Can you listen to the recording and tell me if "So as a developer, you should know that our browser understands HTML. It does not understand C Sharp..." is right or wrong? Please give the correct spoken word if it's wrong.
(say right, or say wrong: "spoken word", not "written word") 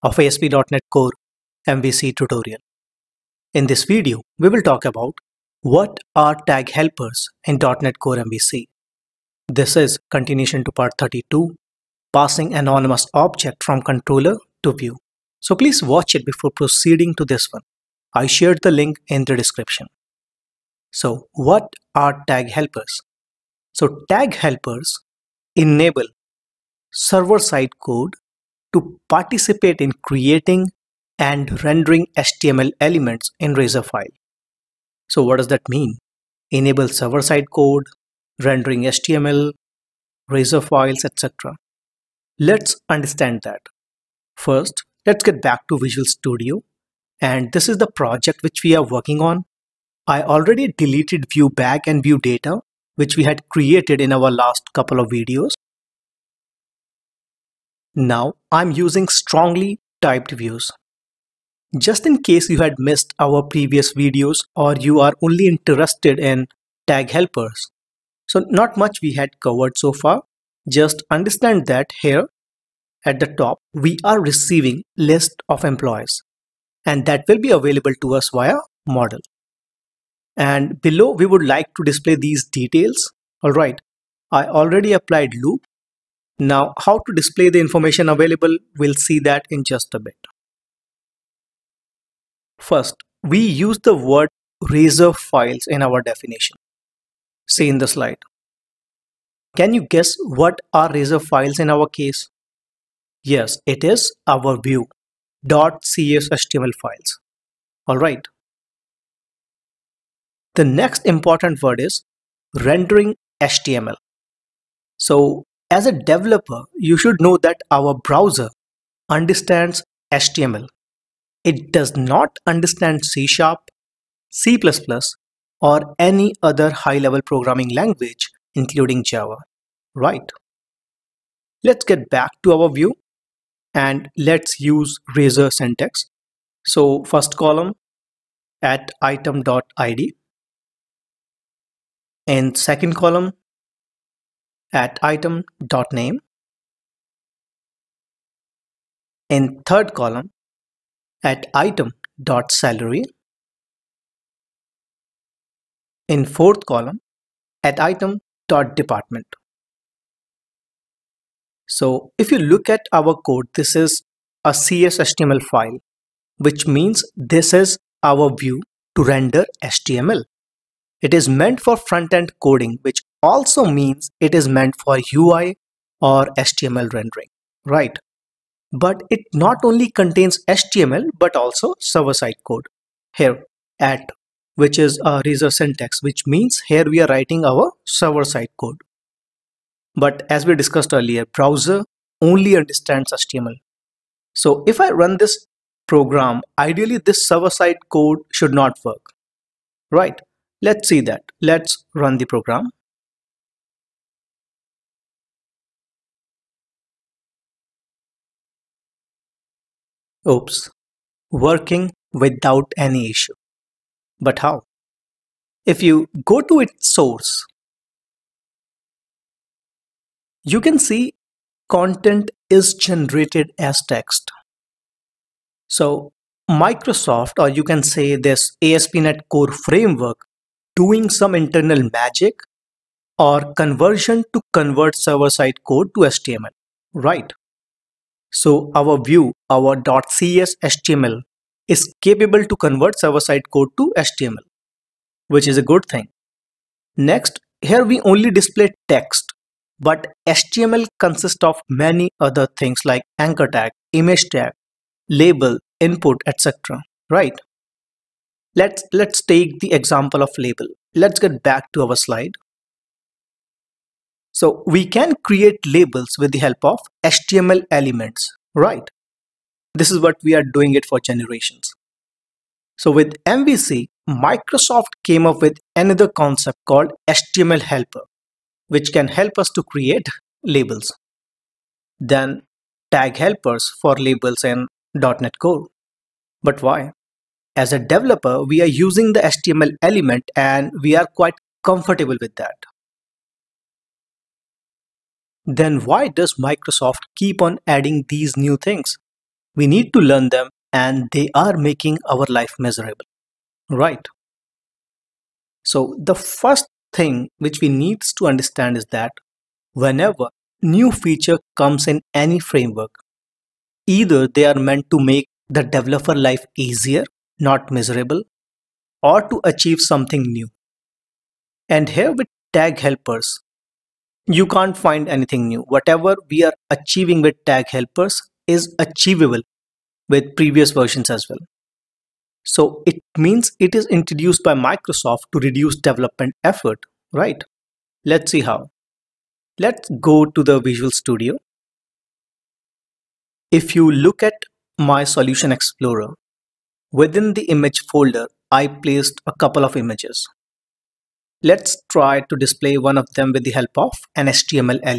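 right.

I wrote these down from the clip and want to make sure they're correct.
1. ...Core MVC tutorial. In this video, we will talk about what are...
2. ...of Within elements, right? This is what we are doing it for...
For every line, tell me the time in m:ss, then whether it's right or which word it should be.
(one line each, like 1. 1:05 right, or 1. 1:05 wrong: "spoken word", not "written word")
1. 0:00 right
2. 4:26 wrong: "HTML", not "Within".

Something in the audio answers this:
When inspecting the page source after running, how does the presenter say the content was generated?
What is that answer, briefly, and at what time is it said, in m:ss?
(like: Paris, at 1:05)
As text, at 3:42.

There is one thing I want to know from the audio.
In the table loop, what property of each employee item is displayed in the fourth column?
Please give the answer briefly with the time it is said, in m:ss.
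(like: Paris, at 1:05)
Department, at 2:37.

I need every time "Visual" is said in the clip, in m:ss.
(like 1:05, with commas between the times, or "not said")
0:45, 5:40.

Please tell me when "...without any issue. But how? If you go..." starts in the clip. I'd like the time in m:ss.
3:32.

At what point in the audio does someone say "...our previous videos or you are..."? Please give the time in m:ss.
1:03.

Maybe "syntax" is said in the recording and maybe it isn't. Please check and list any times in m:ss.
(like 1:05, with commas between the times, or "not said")
2:15, 3:05.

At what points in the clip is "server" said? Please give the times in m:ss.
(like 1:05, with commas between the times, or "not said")
0:26, 0:36, 3:01, 3:07, 3:17, 3:54, 4:02.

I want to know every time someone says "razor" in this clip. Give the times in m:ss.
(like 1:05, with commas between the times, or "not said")
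0:33, 0:40, 1:34, 1:40, 2:15, 3:05.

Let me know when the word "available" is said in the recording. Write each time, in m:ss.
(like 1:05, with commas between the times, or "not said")
1:17, 1:28.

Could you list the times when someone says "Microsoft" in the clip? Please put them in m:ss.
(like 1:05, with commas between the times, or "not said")
3:46, 4:34, 4:56, 5:34.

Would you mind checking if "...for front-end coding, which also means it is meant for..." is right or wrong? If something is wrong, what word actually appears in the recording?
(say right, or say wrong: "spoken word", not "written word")
right.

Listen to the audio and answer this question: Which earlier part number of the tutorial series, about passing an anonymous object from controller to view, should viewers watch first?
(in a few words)
32.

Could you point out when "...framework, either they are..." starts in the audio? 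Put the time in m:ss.
5:12.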